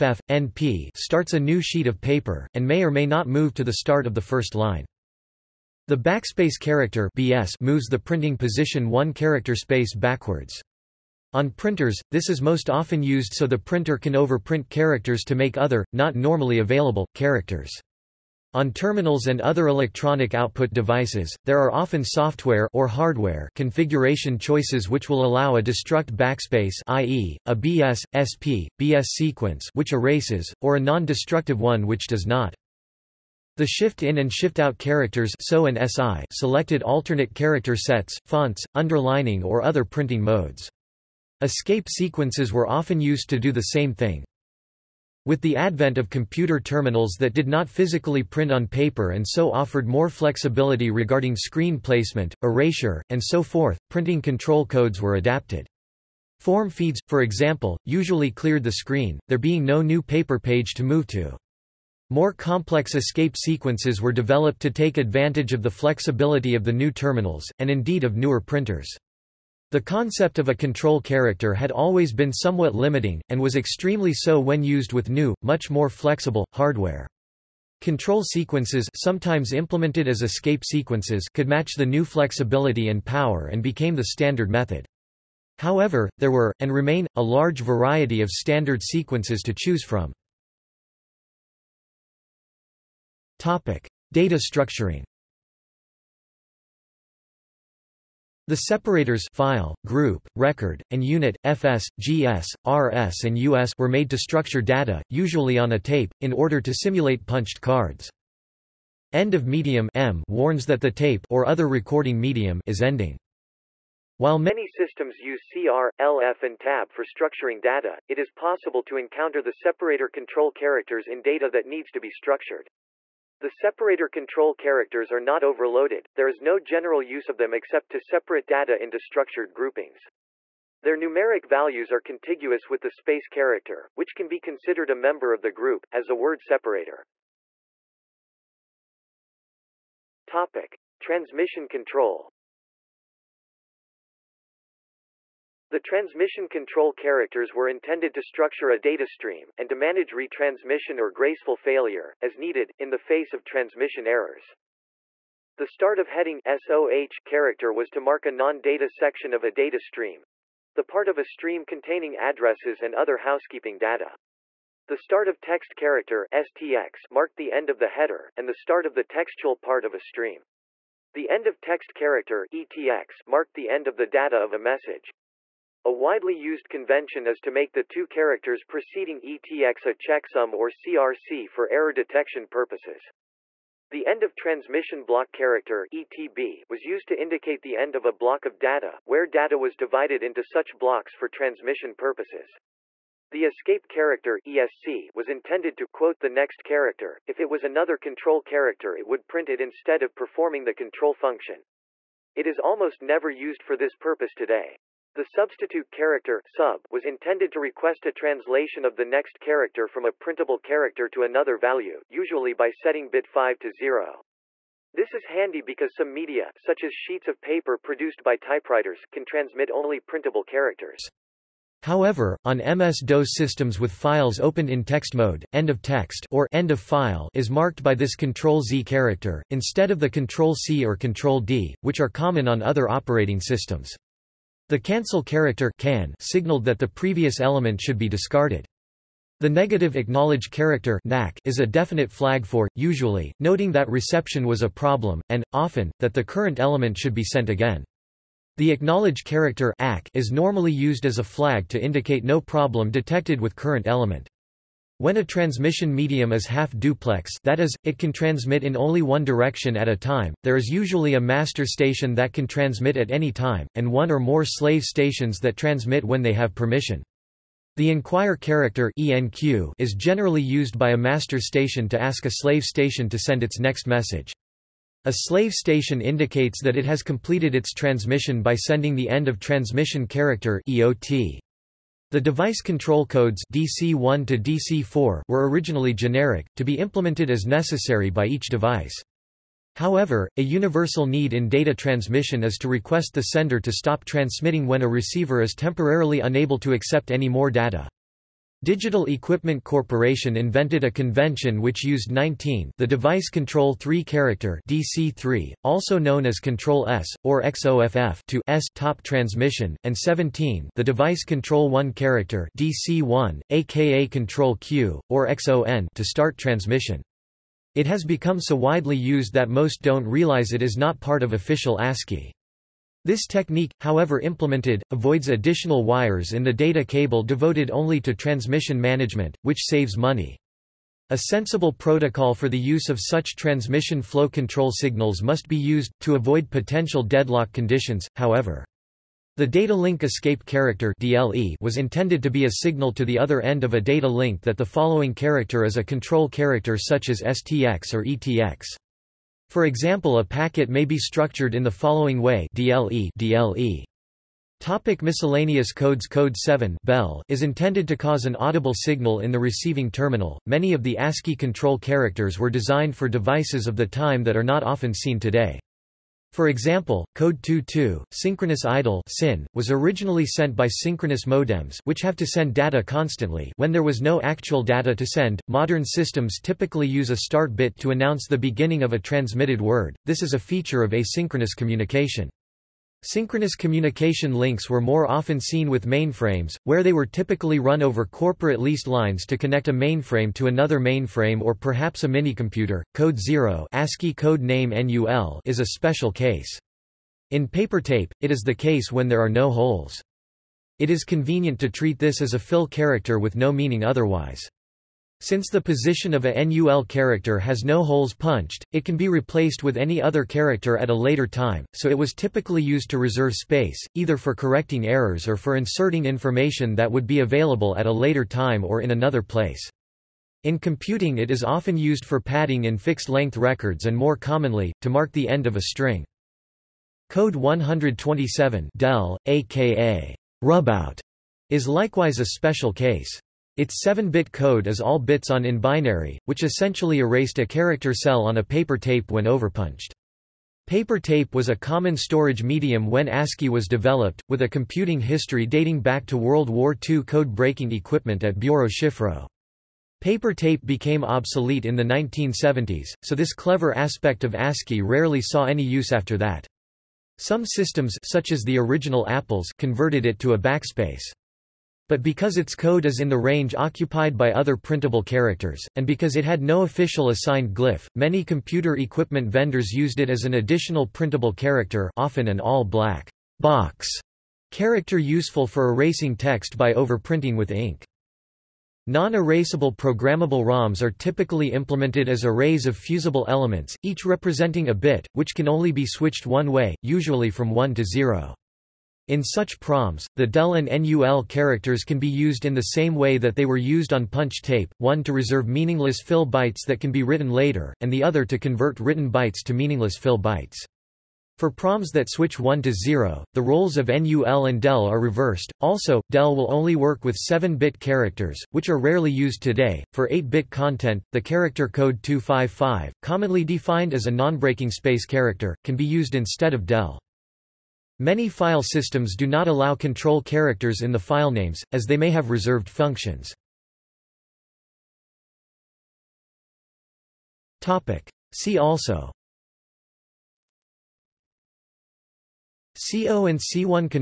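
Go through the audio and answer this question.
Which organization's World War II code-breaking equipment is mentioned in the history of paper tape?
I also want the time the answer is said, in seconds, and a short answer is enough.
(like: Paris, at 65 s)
Biuro Szyfrów, at 448 s.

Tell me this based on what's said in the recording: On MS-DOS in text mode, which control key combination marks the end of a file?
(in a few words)
Control-Z.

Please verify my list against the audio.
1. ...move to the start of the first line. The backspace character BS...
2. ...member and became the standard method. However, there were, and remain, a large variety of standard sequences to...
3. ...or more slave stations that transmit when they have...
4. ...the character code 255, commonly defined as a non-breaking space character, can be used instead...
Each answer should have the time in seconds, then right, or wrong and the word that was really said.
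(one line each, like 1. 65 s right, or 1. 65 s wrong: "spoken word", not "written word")
1. 3 s right
2. 83 s wrong: "power", not "member"
3. 264 s right
4. 511 s right.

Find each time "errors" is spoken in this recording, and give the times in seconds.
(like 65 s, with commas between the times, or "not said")
154 s, 181 s, 414 s.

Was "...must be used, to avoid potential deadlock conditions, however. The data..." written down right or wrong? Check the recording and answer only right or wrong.
right.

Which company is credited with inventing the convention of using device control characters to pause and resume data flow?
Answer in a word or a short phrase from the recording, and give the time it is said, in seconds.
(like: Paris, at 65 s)
Digital Equipment Corporation, at 298 s.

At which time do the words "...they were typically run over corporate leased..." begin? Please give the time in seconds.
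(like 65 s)
386 s.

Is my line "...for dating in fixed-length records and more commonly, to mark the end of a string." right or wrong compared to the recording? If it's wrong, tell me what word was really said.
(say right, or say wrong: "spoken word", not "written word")
wrong: "padding", not "dating".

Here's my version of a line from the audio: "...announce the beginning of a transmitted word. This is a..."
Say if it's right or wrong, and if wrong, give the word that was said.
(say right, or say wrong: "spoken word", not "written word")
right.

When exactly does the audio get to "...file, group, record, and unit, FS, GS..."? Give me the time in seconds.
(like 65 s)
99 s.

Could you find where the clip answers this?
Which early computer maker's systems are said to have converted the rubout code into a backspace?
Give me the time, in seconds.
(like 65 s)
459 s.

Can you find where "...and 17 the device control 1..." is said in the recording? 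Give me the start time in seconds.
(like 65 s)
309 s.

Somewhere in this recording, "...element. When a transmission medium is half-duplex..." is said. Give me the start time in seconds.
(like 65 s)
253 s.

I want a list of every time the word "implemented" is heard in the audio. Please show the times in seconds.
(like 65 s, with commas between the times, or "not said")
79 s, 286 s, 324 s, 481 s.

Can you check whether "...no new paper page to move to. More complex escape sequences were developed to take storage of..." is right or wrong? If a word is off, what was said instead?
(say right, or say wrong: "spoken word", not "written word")
wrong: "advantage", not "storage".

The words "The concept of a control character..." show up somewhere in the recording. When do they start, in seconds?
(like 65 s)
69 s.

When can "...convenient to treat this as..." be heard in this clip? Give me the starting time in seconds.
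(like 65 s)
401 s.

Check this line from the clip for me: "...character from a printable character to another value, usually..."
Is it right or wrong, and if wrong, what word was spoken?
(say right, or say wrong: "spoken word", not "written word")
right.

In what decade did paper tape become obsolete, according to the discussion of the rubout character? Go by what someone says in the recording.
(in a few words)
1970s.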